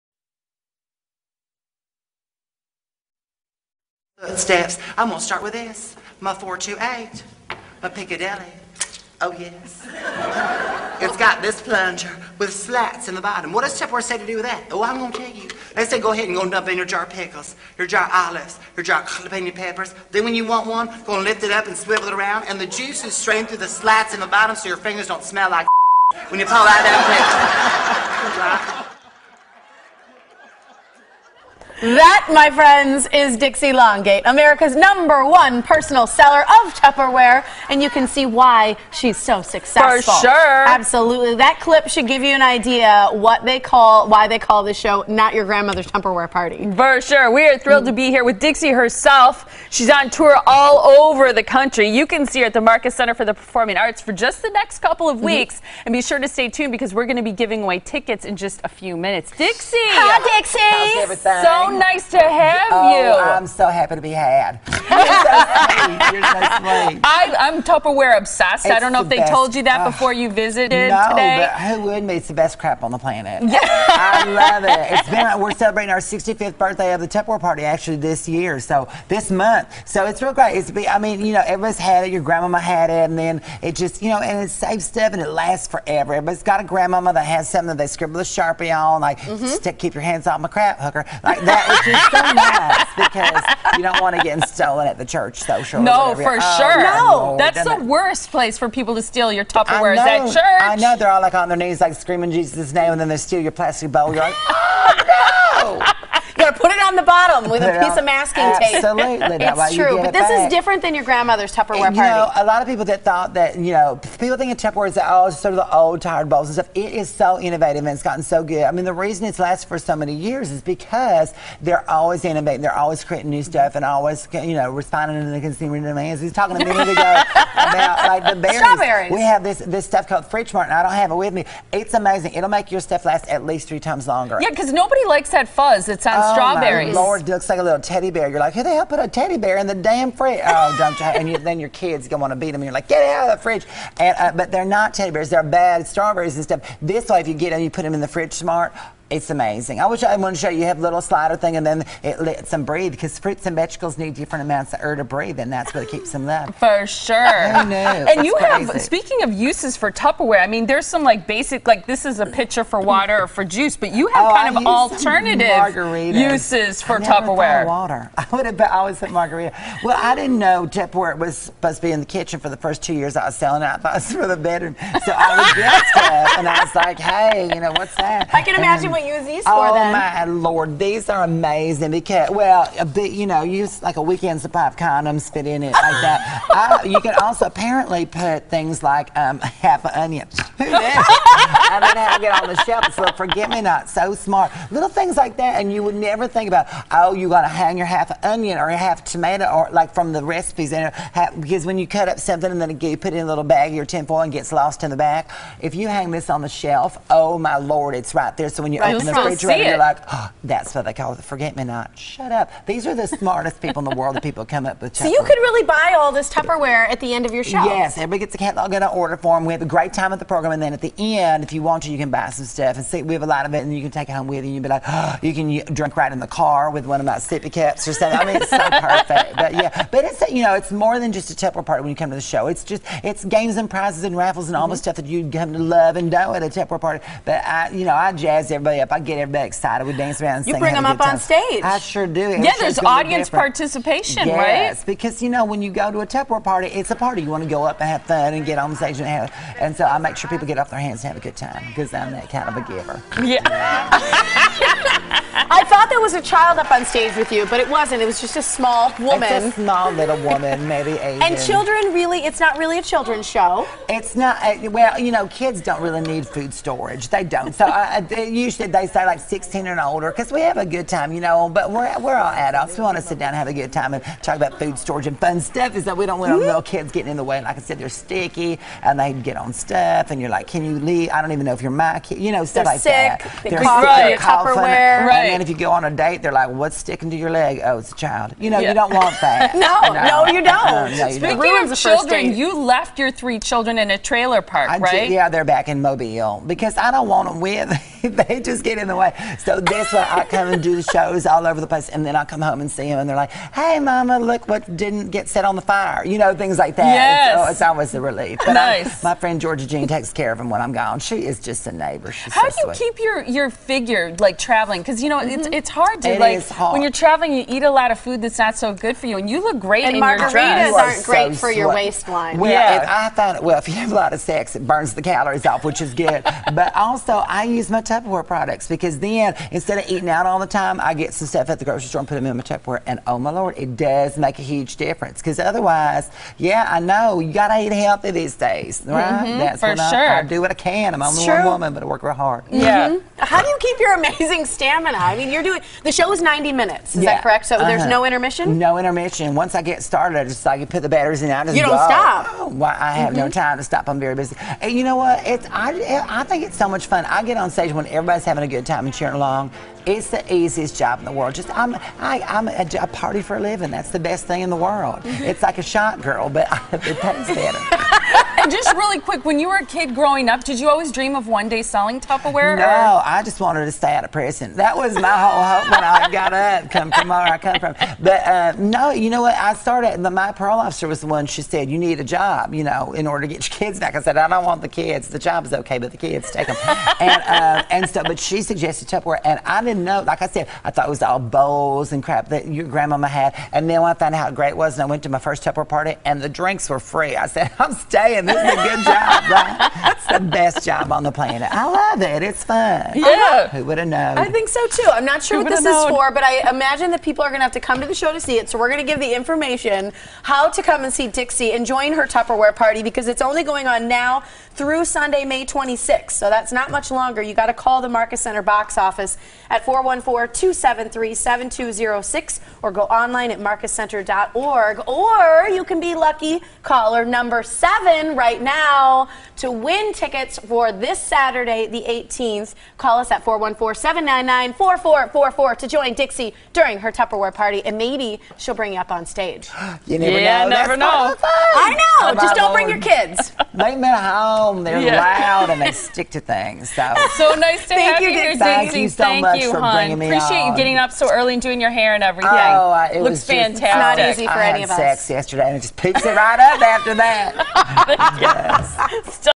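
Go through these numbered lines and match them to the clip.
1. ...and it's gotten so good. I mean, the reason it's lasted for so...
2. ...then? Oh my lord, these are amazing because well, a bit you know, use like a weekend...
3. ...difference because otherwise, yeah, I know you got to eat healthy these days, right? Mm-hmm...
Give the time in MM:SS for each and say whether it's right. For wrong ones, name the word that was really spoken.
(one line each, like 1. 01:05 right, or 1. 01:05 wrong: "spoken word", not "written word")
1. 01:57 right
2. 02:59 right
3. 05:34 right.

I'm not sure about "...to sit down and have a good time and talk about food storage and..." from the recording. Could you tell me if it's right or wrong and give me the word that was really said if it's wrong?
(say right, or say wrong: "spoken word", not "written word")
right.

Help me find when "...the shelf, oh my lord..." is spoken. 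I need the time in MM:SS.
03:26.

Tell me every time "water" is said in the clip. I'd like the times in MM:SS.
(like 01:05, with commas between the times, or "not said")
02:42, 02:47.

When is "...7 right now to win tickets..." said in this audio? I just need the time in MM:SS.
07:07.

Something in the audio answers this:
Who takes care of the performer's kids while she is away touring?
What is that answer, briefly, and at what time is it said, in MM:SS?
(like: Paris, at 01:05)
Georgia Jean, at 05:09.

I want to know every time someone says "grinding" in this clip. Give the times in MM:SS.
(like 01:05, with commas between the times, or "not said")
not said.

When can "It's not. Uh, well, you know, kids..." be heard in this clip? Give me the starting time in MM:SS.
04:23.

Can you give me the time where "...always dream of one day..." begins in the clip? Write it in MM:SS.
06:10.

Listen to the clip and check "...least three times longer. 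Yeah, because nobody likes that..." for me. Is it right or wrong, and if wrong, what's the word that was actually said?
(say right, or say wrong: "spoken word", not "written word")
right.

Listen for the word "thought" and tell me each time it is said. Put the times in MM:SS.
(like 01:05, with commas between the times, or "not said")
01:53, 02:53, 04:15, 06:30.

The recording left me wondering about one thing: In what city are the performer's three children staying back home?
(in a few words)
Mobile.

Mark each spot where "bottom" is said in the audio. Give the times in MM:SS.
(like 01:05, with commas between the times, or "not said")
00:13, 00:24, 01:47.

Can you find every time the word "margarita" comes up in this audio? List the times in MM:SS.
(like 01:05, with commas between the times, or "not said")
02:49, 05:20.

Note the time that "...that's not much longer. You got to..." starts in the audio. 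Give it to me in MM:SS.
06:56.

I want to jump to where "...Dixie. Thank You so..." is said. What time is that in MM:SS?
07:28.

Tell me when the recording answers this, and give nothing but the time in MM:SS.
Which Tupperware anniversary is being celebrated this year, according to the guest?
01:15.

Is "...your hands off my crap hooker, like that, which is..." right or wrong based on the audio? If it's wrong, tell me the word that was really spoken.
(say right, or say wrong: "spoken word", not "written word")
right.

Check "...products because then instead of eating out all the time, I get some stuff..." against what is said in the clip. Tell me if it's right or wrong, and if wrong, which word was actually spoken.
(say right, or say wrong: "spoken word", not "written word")
right.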